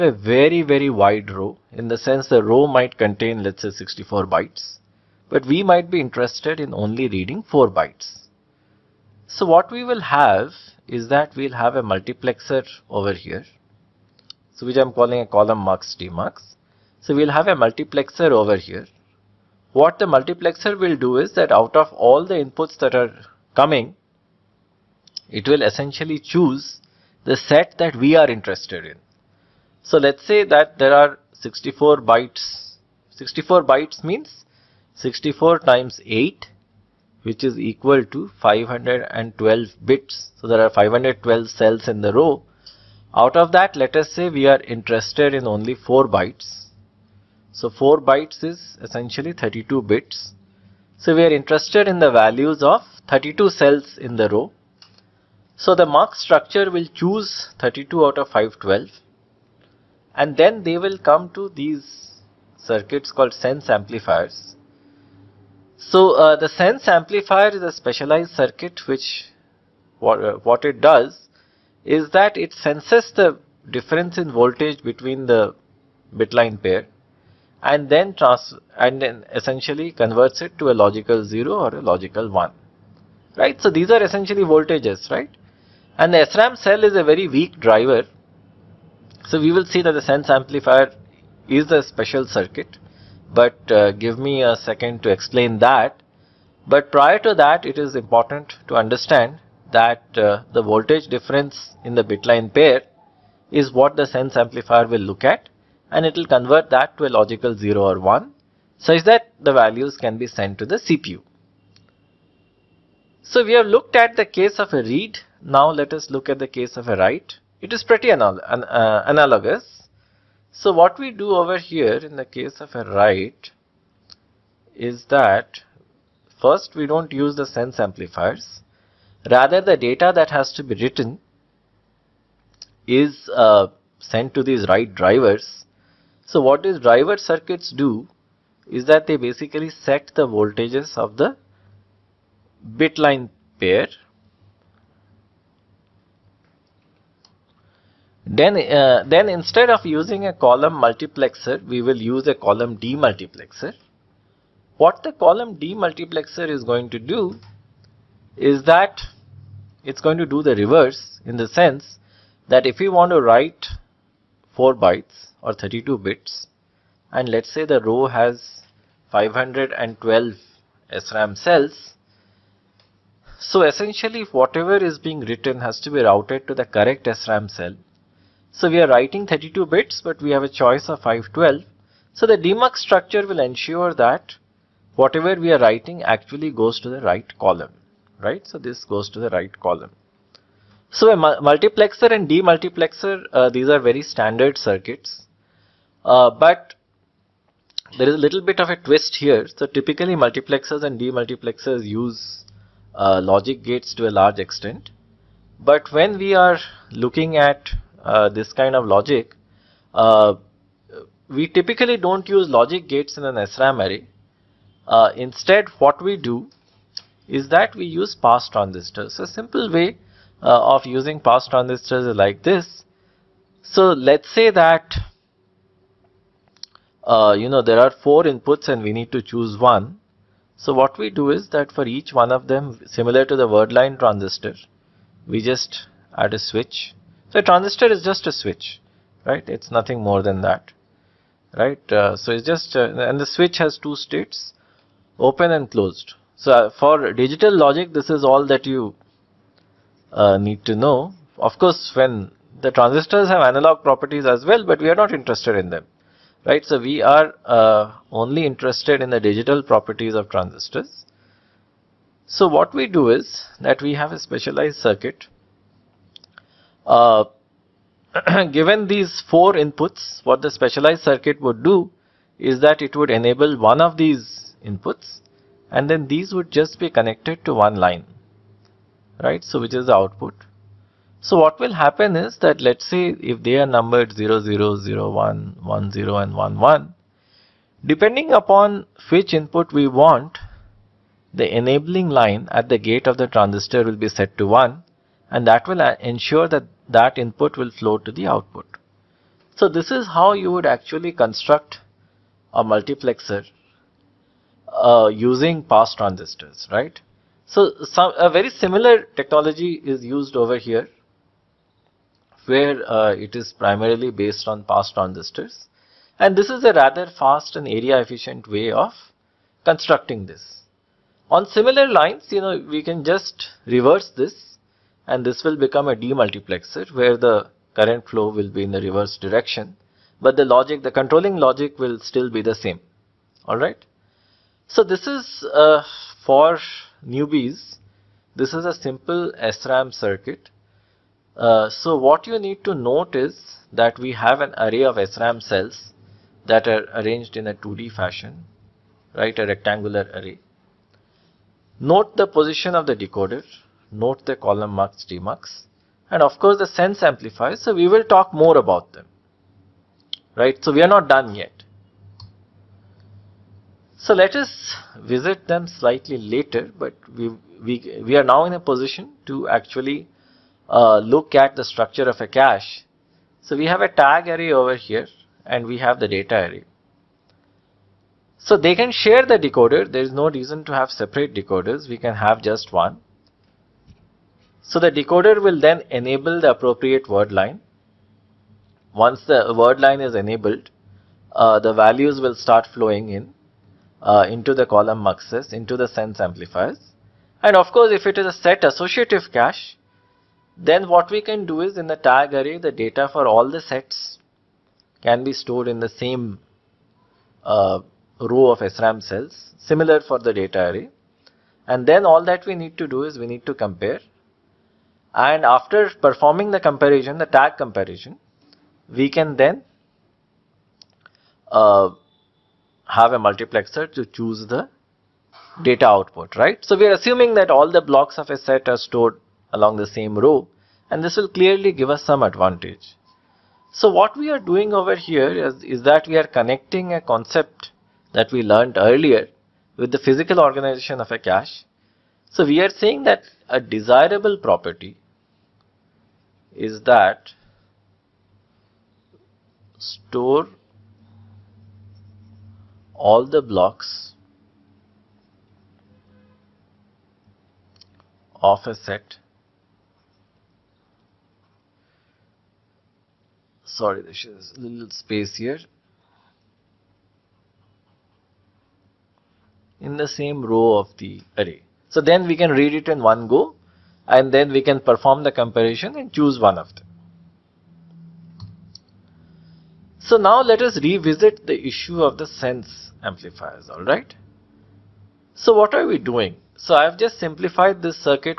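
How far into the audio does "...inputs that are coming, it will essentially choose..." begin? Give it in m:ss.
0:22.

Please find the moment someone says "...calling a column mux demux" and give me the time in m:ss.
0:14.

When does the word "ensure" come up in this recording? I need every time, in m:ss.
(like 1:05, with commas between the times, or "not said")
3:03, 4:55.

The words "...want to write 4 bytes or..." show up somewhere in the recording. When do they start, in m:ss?
2:42.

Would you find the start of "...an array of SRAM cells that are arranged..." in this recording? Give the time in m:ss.
5:44.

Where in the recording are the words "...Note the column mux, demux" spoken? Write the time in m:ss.
5:53.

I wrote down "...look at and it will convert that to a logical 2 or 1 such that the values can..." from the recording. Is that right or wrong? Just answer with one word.
wrong.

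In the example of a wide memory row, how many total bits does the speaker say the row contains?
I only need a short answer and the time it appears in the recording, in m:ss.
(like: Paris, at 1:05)
512, at 0:38.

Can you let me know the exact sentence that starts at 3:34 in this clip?
Uh, instead, what we do is that we use pass transistors.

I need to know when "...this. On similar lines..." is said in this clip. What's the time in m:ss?
5:20.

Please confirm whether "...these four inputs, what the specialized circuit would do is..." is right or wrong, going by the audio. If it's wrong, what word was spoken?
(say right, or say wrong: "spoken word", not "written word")
right.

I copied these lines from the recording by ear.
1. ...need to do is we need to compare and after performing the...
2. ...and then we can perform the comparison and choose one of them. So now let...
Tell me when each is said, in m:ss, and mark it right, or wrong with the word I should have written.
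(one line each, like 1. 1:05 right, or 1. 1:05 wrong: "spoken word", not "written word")
1. 6:52 right
2. 7:54 right.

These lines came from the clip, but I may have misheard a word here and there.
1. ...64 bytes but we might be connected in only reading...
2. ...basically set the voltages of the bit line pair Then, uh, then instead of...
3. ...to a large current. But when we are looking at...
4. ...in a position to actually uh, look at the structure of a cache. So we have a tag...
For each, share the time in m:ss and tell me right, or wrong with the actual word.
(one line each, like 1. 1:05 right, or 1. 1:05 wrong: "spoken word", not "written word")
1. 0:03 wrong: "interested", not "connected"
2. 2:19 right
3. 3:23 wrong: "extent", not "current"
4. 6:08 right.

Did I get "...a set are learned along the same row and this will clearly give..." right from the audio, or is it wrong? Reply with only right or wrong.
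wrong.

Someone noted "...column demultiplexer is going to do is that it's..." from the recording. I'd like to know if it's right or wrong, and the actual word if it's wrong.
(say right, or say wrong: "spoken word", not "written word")
right.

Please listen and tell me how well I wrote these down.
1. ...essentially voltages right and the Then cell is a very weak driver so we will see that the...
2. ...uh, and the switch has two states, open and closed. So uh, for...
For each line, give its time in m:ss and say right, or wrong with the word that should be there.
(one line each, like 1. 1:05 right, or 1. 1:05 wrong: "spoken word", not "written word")
1. 1:24 wrong: "SRAM", not "Then"
2. 4:02 right.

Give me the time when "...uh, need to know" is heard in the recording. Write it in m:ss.
4:10.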